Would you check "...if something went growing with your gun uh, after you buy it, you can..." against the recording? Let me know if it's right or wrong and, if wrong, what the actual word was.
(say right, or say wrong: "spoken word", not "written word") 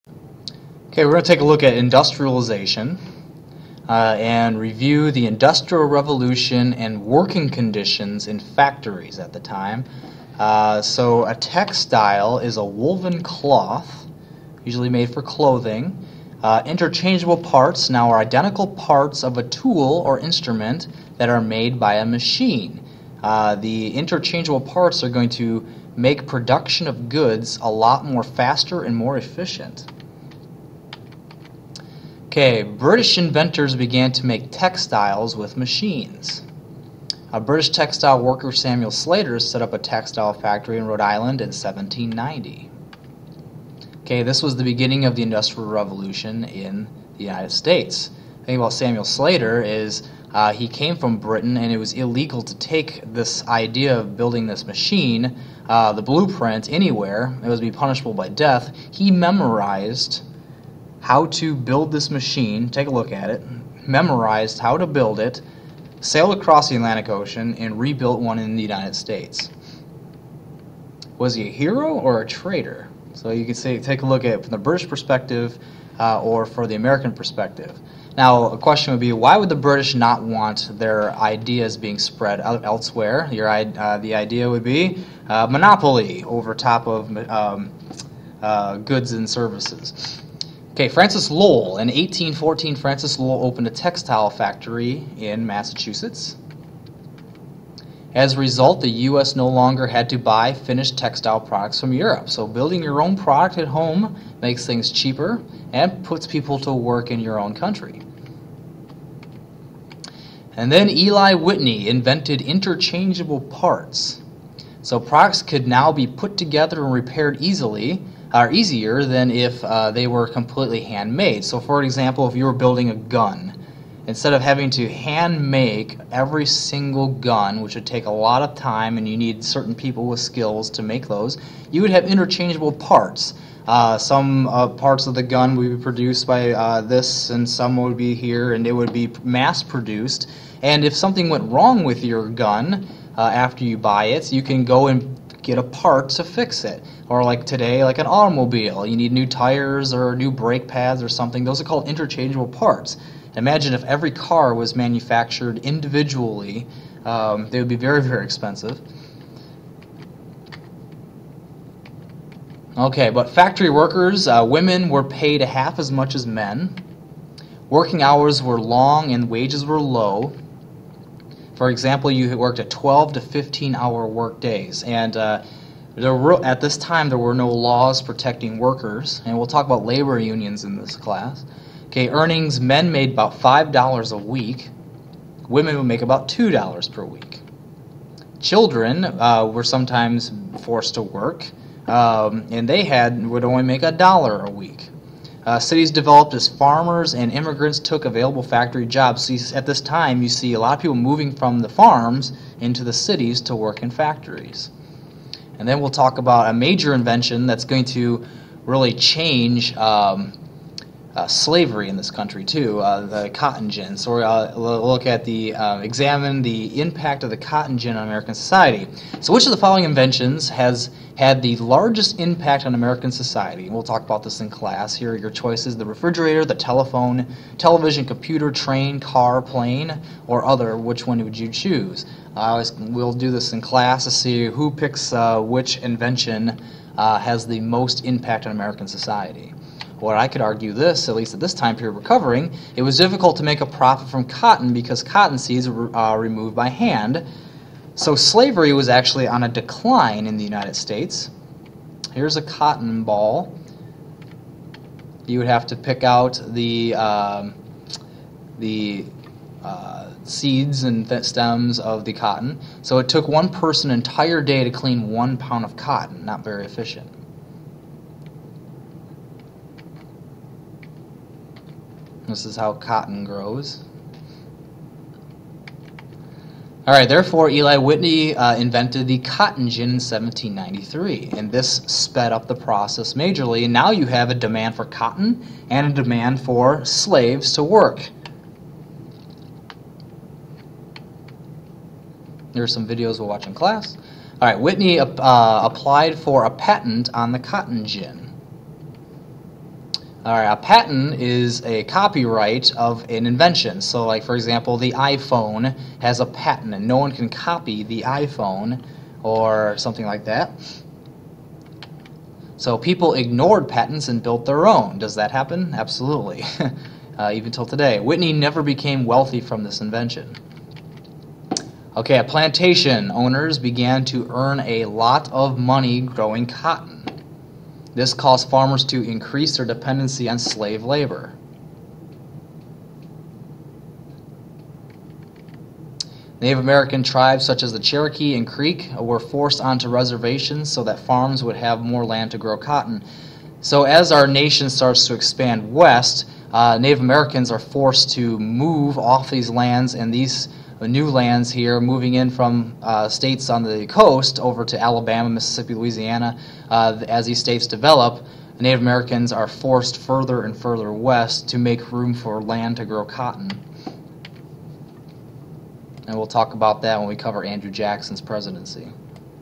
wrong: "wrong", not "growing".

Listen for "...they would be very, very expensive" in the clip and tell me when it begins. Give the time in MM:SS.
02:37.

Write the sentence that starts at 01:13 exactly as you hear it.
So you can say, take a look at it from the British perspective uh, or for the American perspective.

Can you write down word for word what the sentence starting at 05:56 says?
Uh, as these states develop, Native Americans are forced further and further west to make room for land to grow cotton.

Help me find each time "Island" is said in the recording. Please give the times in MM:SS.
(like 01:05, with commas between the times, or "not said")
00:41.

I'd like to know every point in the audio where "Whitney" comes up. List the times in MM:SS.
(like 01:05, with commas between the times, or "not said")
01:51, 04:37, 04:54, 05:17.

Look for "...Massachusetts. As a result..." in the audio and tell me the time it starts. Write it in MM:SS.
01:35.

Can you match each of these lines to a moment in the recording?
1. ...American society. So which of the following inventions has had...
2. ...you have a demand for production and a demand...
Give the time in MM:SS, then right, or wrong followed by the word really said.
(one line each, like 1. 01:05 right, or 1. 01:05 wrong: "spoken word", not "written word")
1. 03:38 right
2. 04:43 wrong: "cotton", not "production".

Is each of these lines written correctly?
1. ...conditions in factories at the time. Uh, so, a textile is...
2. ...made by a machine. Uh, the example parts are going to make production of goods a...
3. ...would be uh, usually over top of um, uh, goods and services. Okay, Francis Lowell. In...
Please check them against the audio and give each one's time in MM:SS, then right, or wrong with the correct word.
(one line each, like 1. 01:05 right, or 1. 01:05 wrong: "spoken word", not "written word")
1. 00:07 right
2. 00:21 wrong: "interchangeable", not "example"
3. 01:24 wrong: "monopoly", not "usually".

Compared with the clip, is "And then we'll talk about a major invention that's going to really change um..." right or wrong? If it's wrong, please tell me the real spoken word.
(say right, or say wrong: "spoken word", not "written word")
right.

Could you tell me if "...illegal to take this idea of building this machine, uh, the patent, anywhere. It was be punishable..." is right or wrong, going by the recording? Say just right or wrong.
wrong.